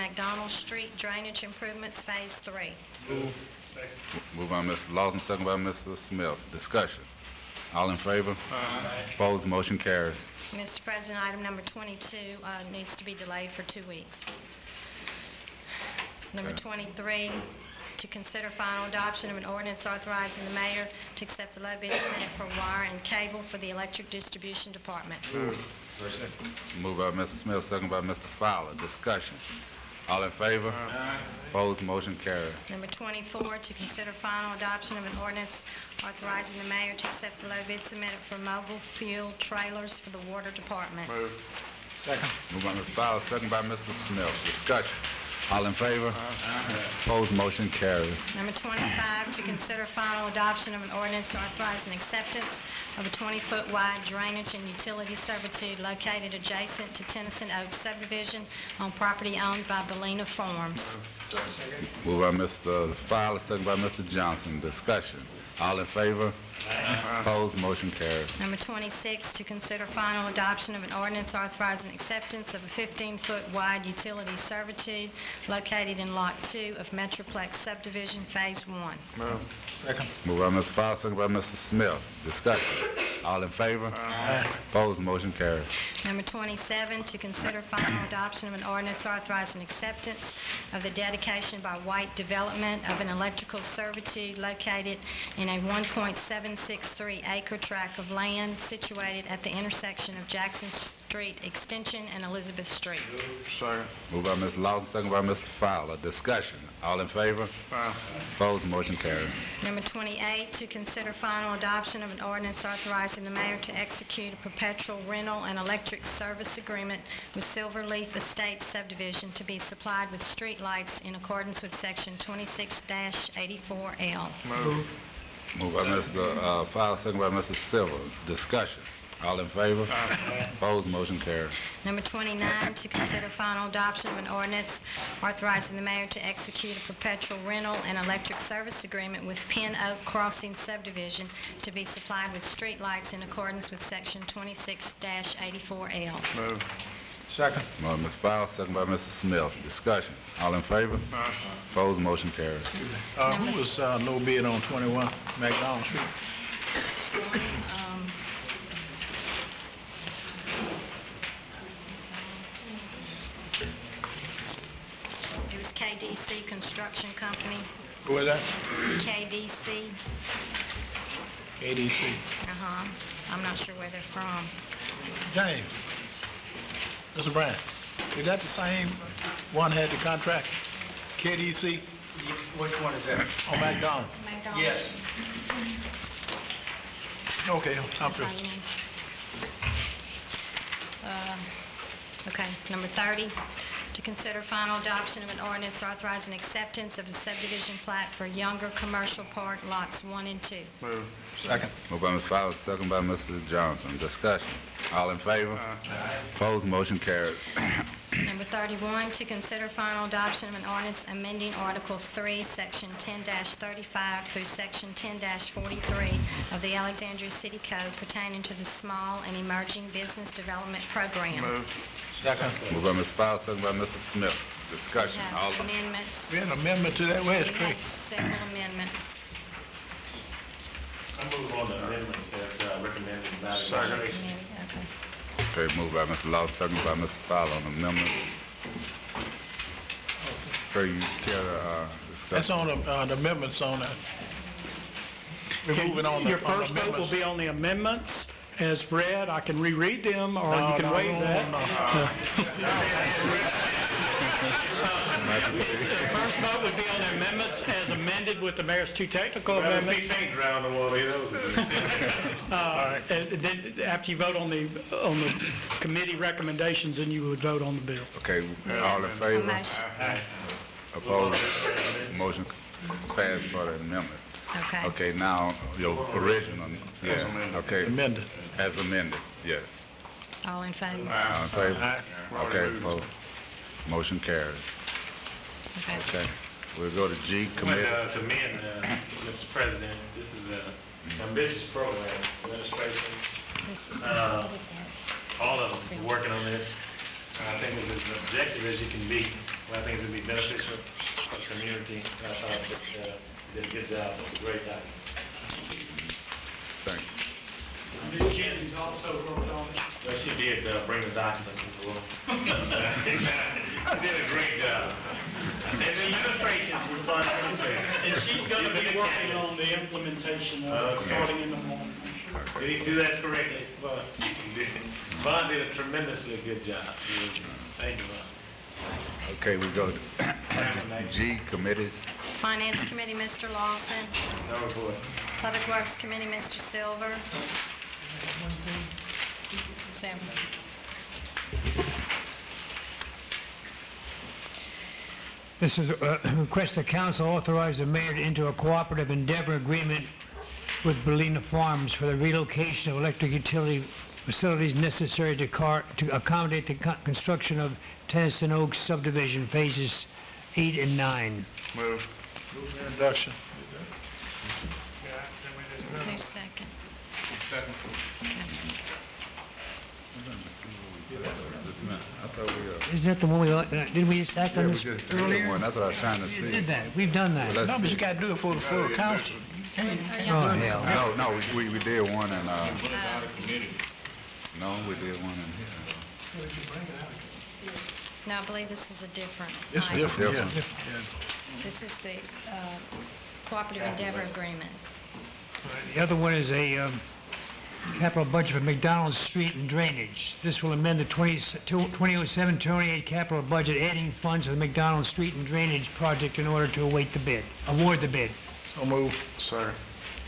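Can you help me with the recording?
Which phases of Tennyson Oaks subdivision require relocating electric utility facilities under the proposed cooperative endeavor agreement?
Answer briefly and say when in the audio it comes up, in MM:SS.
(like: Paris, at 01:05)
Phases 8 and 9, at 05:59.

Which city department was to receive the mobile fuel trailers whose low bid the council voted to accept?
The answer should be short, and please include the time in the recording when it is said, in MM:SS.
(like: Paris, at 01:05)
Water department, at 00:40.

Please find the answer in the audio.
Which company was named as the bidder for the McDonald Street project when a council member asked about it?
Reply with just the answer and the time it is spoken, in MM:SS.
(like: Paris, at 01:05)
KDC Construction Company, at 02:46.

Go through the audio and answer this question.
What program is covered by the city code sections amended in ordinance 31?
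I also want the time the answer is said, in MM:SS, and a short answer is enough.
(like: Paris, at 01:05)
Small and Emerging Business Development Program, at 03:38.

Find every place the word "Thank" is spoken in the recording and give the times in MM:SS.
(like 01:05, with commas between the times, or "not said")
05:06, 05:27.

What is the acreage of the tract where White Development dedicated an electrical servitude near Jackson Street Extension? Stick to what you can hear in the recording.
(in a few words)
1.763 acres.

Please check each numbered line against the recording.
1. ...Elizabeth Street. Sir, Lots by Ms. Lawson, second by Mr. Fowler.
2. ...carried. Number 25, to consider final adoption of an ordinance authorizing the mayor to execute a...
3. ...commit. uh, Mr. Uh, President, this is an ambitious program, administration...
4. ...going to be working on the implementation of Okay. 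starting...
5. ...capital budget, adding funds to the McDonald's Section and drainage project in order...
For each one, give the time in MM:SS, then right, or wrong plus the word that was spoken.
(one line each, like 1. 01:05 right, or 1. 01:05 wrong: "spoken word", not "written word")
1. 01:42 wrong: "Moved", not "Lots"
2. 01:48 wrong: "28", not "25"
3. 04:47 right
4. 05:18 right
5. 06:43 wrong: "Street", not "Section".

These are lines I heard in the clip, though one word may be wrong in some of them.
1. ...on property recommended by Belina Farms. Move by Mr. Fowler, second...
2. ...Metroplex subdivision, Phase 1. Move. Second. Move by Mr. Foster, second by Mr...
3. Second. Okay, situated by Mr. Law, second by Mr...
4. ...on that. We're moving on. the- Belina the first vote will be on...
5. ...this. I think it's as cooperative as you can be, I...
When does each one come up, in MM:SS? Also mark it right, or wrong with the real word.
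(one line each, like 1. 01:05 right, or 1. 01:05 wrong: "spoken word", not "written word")
1. 00:58 wrong: "owned", not "recommended"
2. 01:16 right
3. 03:53 wrong: "moved", not "situated"
4. 04:03 wrong: "Your", not "Belina"
5. 04:56 wrong: "objective", not "cooperative".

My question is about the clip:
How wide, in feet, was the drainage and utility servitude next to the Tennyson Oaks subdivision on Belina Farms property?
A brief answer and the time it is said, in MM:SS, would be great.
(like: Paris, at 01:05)
20-foot, at 00:53.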